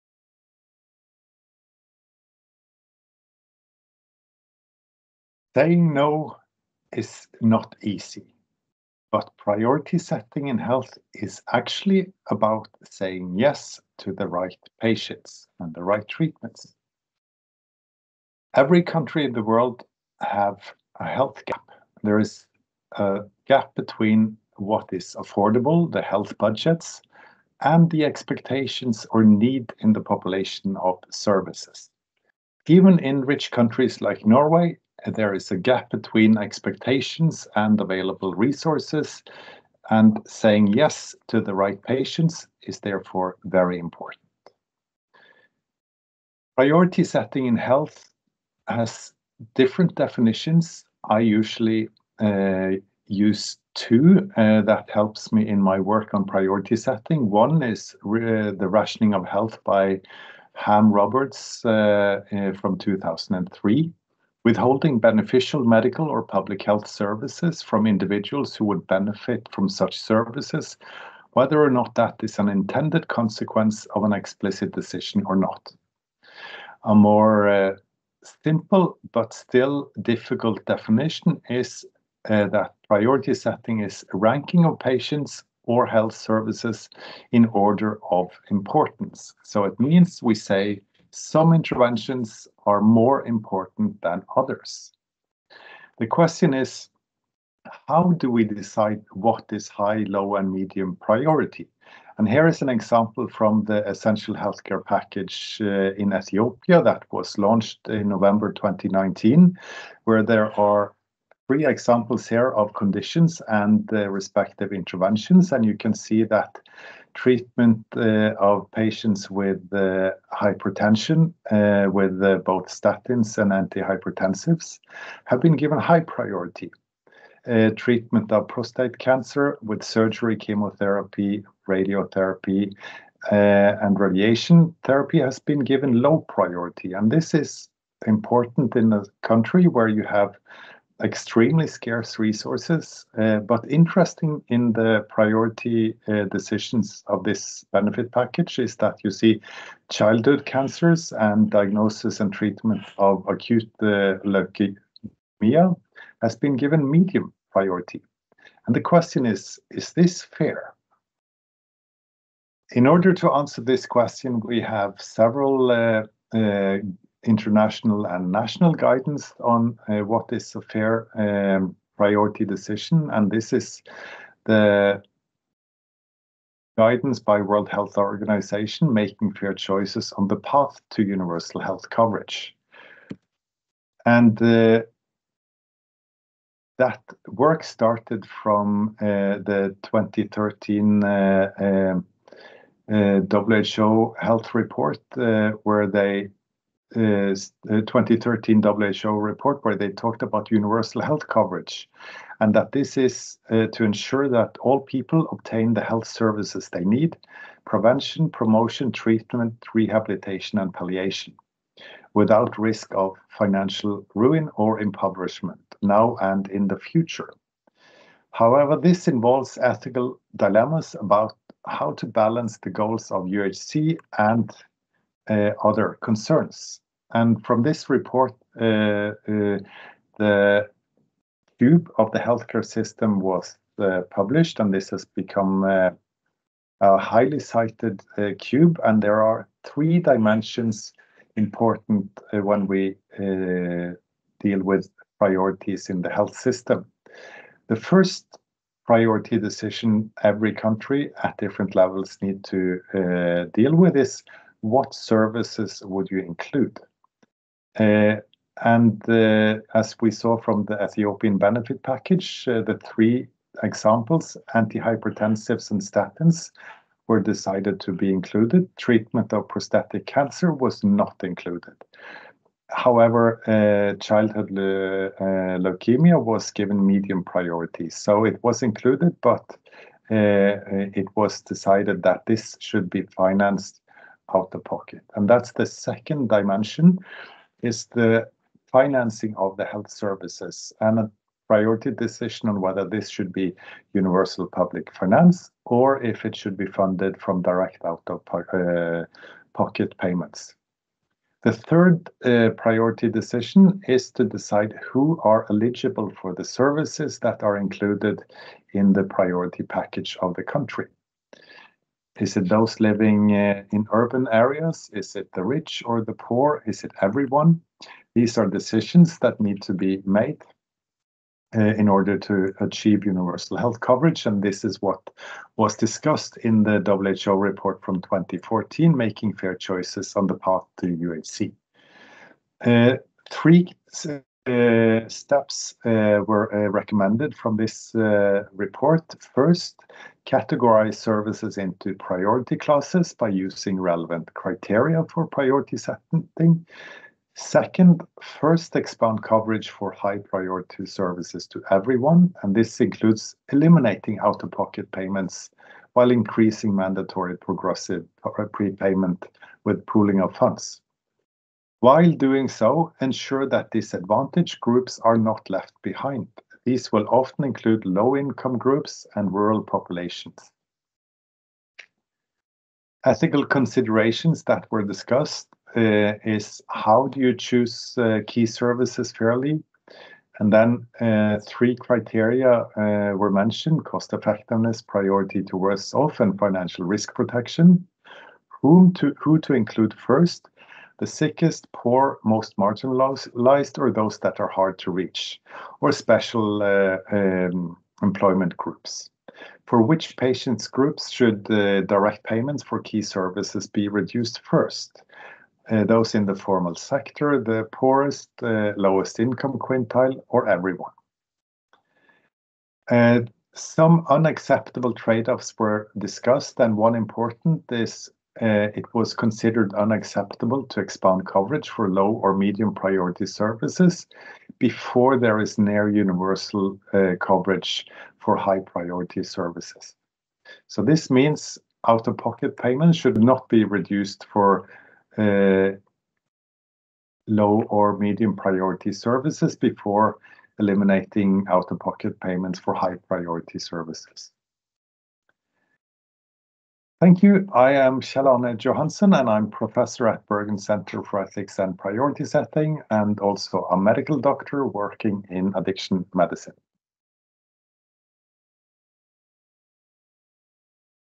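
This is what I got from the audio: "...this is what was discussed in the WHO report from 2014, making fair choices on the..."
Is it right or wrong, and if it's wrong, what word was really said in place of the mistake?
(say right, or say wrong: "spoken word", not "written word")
right.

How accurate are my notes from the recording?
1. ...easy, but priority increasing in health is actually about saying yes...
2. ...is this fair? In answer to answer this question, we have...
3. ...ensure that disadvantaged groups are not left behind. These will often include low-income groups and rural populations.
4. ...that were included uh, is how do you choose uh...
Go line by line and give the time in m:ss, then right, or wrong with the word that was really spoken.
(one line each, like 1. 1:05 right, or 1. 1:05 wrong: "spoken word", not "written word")
1. 0:07 wrong: "setting", not "increasing"
2. 2:39 wrong: "order", not "answer"
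3. 6:03 right
4. 6:14 wrong: "discussed", not "included".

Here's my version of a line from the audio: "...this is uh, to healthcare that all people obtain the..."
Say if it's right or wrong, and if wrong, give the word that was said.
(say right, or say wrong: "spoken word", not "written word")
wrong: "ensure", not "healthcare".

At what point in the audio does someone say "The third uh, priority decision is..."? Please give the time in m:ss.
5:01.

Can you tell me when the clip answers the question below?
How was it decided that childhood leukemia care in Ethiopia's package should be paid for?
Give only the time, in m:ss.
4:44.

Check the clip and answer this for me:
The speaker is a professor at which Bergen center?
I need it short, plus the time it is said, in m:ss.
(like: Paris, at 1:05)
Bergen Center for Ethics and Priority Setting, at 7:30.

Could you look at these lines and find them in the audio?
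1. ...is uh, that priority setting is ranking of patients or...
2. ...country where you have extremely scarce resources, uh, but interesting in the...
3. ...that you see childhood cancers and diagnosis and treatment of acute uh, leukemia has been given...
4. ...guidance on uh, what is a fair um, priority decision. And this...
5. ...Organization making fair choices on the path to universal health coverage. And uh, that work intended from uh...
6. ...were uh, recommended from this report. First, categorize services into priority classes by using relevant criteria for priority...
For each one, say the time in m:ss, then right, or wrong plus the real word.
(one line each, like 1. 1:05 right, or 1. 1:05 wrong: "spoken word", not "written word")
1. 1:21 right
2. 2:19 right
3. 2:28 right
4. 2:48 right
5. 2:57 wrong: "started", not "intended"
6. 5:36 right.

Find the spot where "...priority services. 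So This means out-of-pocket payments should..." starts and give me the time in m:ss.
7:08.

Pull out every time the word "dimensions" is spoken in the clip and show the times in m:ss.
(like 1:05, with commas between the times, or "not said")
3:59, 4:46.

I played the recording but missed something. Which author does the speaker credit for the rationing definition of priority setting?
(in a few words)
Ham Roberts.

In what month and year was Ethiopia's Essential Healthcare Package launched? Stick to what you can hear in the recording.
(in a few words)
November 2019.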